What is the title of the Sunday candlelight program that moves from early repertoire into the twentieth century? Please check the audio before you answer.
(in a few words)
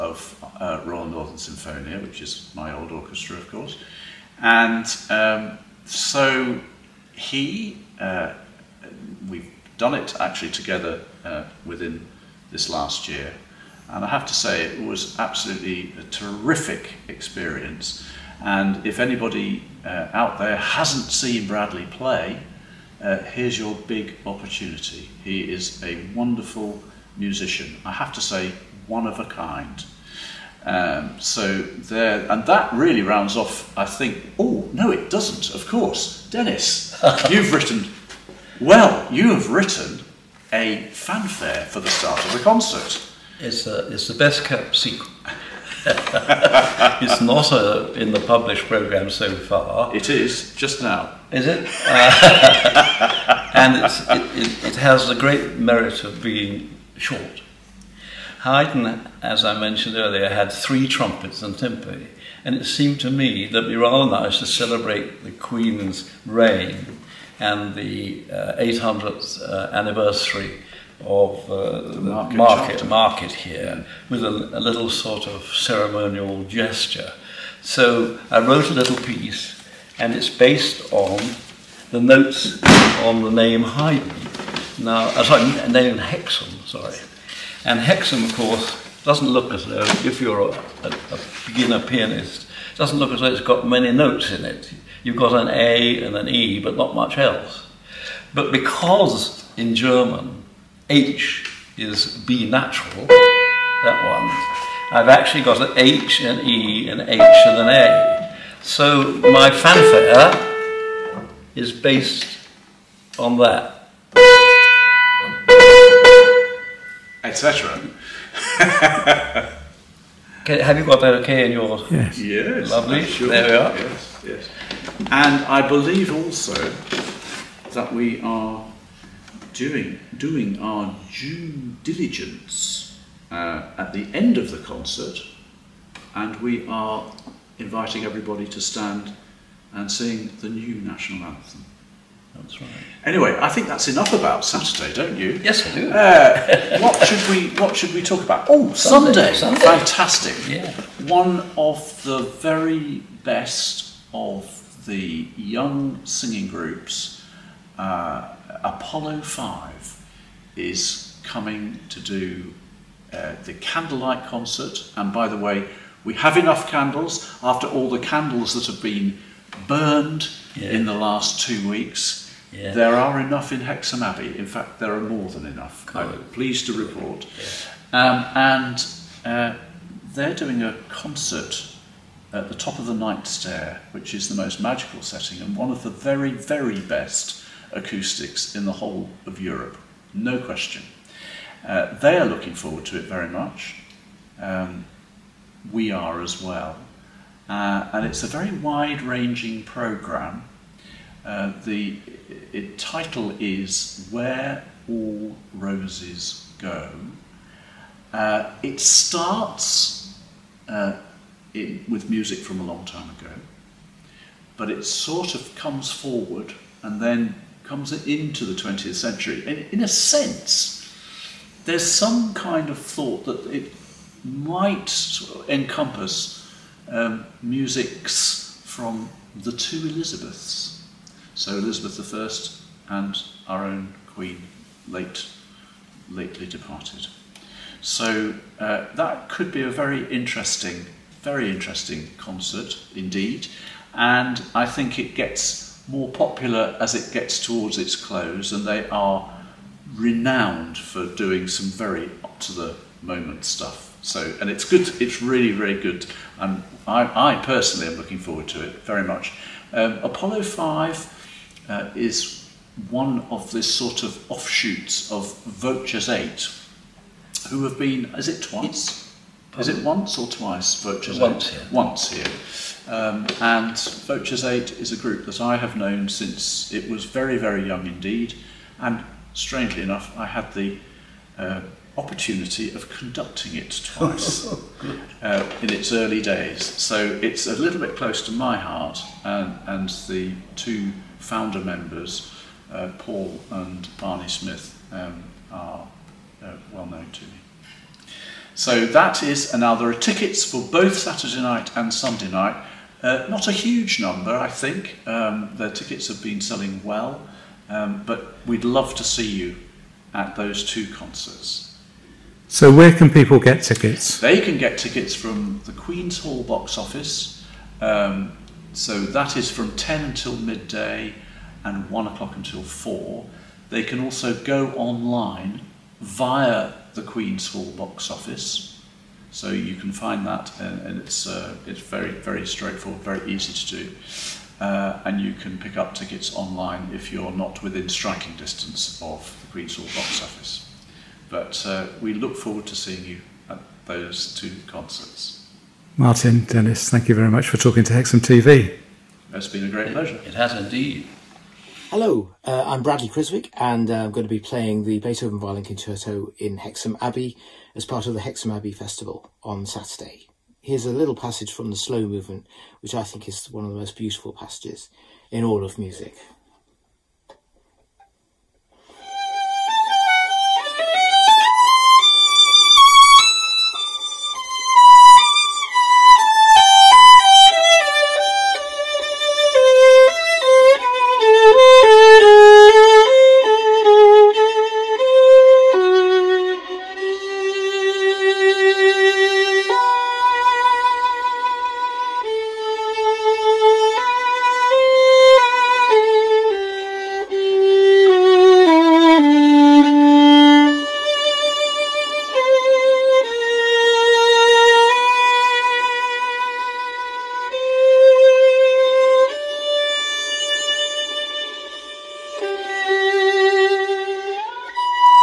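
Where All Roses Go.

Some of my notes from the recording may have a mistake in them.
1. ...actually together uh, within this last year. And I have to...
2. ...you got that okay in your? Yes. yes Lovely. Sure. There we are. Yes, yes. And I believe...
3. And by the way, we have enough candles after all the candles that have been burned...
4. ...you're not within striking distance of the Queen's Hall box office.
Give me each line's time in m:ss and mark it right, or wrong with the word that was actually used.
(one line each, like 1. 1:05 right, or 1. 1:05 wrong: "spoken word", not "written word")
1. 0:10 right
2. 2:00 right
3. 2:44 right
4. 5:37 right.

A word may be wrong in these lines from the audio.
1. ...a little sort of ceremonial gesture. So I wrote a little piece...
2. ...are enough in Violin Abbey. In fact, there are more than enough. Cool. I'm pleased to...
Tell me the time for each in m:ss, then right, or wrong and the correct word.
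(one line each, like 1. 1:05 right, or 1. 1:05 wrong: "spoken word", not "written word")
1. 1:14 right
2. 2:52 wrong: "Hexham", not "Violin".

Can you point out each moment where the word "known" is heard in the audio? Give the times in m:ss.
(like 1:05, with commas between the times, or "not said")
4:35, 4:56.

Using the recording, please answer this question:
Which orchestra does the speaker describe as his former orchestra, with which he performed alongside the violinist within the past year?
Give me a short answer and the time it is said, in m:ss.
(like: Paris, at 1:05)
Royal Northern Sinfonia, at 0:00.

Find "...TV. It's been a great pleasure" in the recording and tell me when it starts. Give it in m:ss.
5:48.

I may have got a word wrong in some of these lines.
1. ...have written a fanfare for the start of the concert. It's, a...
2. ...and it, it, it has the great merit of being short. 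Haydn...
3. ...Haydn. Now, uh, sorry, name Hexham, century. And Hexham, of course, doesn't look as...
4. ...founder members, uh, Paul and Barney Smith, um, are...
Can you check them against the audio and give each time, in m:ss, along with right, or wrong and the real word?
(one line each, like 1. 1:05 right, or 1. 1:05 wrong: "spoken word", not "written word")
1. 0:39 right
2. 0:53 right
3. 1:23 wrong: "sorry", not "century"
4. 4:51 right.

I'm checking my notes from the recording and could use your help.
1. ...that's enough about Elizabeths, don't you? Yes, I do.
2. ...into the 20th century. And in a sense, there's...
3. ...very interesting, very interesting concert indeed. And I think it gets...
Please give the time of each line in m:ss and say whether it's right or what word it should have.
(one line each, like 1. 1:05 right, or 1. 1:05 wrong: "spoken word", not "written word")
1. 2:23 wrong: "Saturday", not "Elizabeths"
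2. 3:38 right
3. 3:59 right.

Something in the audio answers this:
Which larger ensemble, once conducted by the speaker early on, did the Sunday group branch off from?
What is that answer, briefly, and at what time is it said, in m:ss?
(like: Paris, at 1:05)
Voces Eight, at 4:25.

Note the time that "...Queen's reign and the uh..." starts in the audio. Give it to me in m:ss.
1:05.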